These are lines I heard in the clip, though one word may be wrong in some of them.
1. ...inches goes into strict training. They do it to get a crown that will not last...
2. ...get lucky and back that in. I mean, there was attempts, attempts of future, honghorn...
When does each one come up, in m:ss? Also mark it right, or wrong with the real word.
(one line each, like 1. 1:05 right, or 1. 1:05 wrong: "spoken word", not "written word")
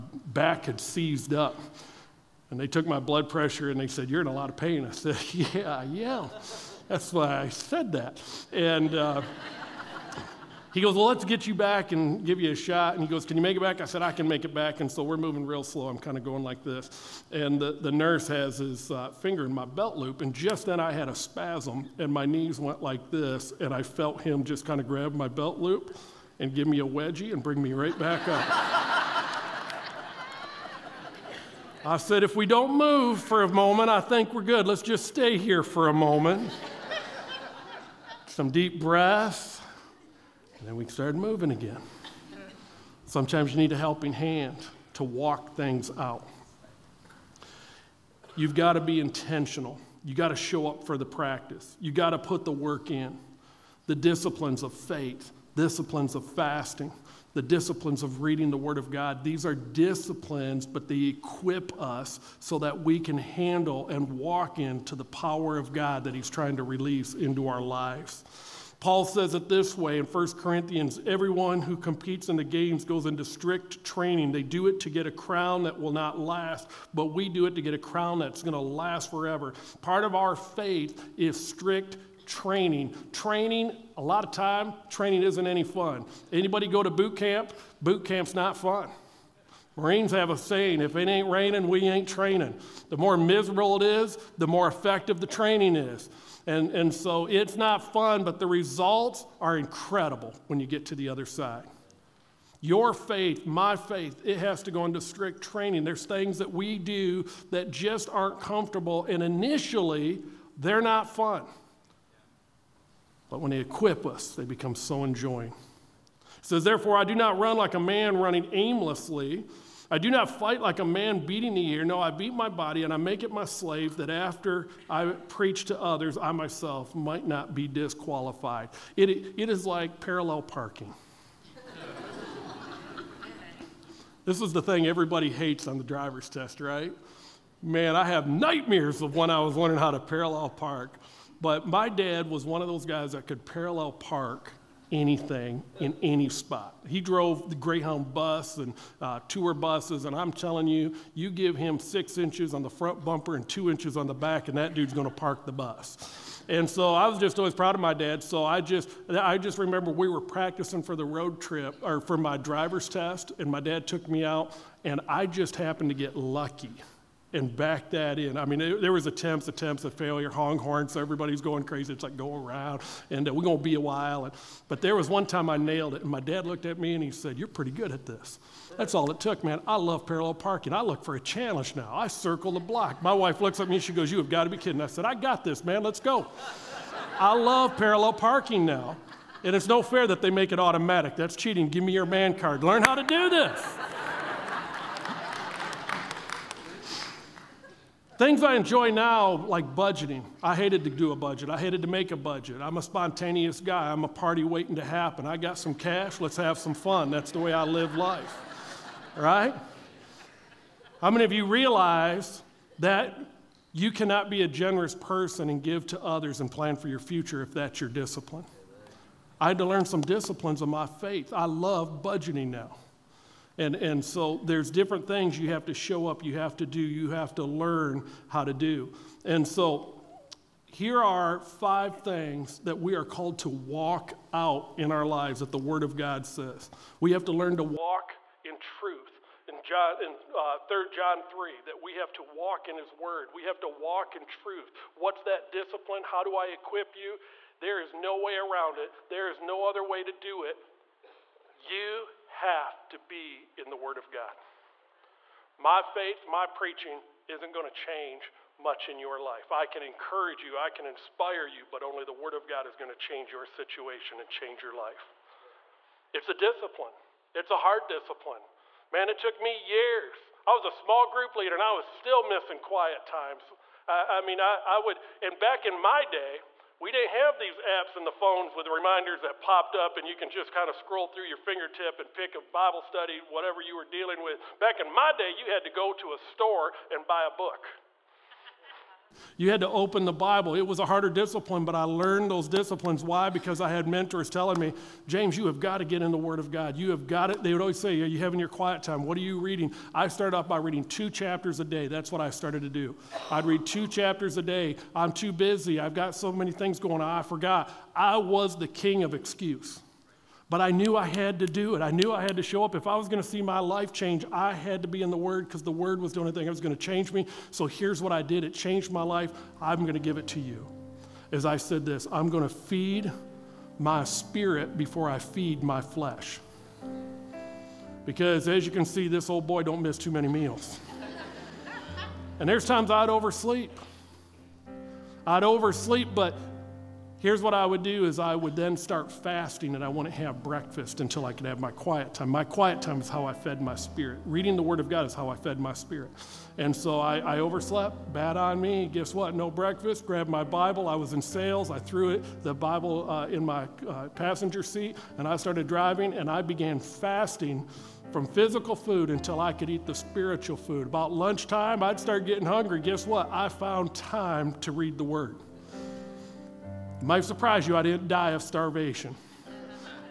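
1. 1:12 wrong: "games", not "inches"
2. 2:45 wrong: "failure", not "future".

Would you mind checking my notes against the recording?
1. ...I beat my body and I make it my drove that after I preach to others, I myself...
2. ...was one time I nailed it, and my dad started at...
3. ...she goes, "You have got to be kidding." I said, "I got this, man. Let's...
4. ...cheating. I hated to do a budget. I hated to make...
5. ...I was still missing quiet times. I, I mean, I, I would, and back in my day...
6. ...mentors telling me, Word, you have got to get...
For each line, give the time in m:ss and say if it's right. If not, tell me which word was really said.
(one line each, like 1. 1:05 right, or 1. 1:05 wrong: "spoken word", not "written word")
1. 2:01 wrong: "slave", not "drove"
2. 2:54 wrong: "looked", not "started"
3. 3:03 right
4. 3:19 wrong: "budgeting", not "cheating"
5. 4:31 right
6. 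4:53 wrong: "James", not "Word".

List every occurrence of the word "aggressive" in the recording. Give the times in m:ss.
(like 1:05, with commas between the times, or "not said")
not said.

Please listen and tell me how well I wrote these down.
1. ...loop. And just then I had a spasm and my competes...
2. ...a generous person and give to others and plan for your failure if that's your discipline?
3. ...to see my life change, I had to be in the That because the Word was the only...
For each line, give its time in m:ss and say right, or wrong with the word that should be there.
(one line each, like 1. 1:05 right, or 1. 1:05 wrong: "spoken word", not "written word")
1. 0:19 wrong: "knees", not "competes"
2. 3:34 wrong: "future", not "failure"
3. 5:13 wrong: "Word", not "That".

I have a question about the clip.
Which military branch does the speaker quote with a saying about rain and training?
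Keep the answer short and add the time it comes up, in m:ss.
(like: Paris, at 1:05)
Marines, at 1:29.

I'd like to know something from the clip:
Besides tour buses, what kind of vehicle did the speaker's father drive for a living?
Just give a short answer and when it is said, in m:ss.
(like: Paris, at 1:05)
Greyhound bus, at 2:27.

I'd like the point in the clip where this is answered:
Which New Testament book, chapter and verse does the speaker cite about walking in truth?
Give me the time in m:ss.
4:00.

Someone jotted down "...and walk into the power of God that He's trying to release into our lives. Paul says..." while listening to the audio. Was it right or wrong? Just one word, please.
right.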